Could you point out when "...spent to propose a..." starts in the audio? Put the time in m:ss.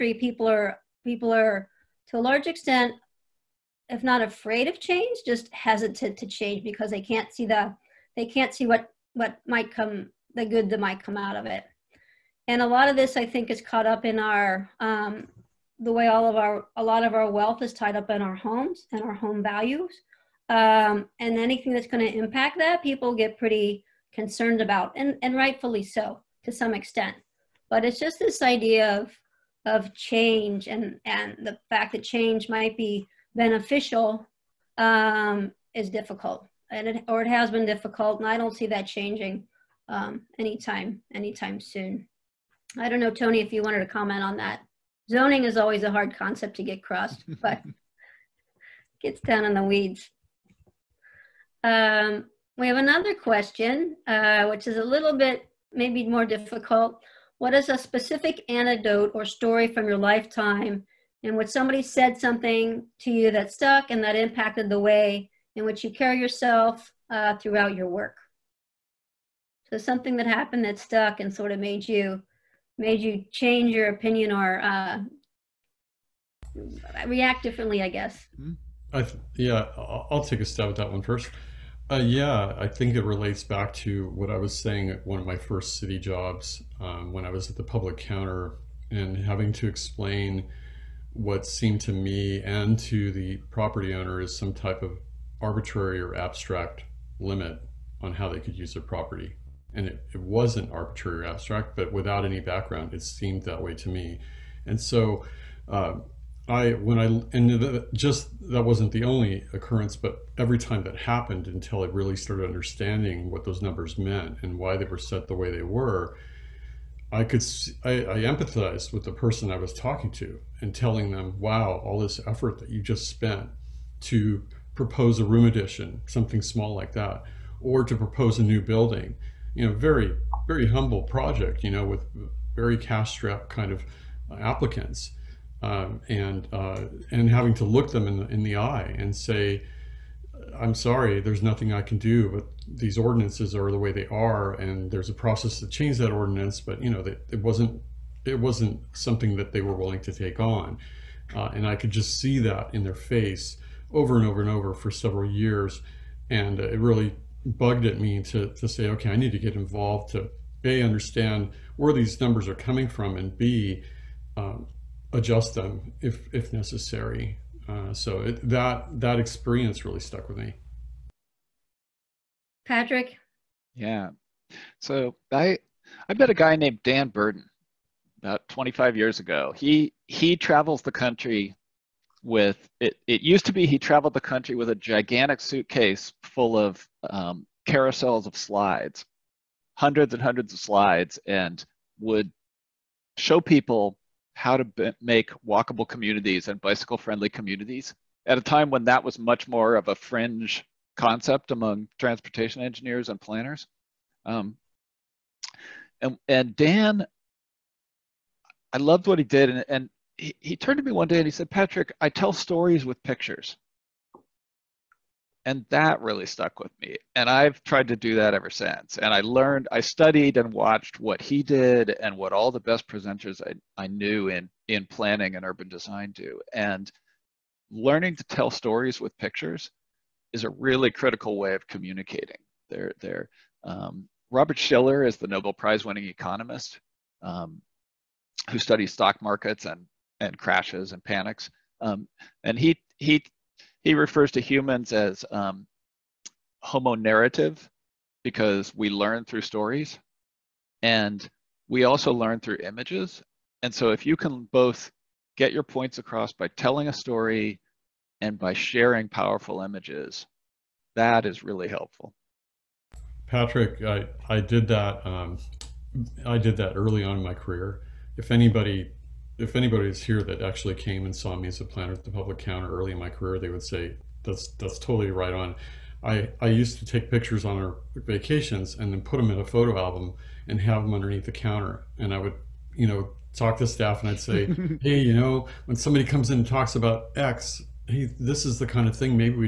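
2:03.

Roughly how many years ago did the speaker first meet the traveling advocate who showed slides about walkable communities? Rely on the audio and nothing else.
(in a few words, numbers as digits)
25.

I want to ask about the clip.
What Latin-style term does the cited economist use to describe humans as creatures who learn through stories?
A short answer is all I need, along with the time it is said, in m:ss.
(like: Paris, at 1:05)
homo narrative, at 4:06.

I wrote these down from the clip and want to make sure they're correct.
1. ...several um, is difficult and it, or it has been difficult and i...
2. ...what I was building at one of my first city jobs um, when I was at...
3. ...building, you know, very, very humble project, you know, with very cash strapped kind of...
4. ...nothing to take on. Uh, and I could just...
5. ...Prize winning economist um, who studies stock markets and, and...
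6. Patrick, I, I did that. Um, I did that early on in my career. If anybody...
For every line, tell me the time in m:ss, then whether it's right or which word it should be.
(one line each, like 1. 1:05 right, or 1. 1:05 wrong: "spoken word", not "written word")
1. 0:33 wrong: "beneficial", not "several"
2. 1:24 wrong: "saying", not "building"
3. 2:08 right
4. 2:29 wrong: "willing", not "nothing"
5. 3:55 right
6. 4:23 right.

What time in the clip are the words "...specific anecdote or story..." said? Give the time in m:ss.
0:57.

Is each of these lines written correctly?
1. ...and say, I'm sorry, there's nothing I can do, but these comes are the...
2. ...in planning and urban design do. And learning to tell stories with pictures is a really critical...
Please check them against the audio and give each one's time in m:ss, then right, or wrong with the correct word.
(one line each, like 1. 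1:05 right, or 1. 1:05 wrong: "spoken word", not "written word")
1. 2:18 wrong: "ordinances", not "comes"
2. 3:44 right.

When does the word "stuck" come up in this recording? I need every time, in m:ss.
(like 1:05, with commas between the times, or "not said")
1:03, 1:10, 2:49, 3:36.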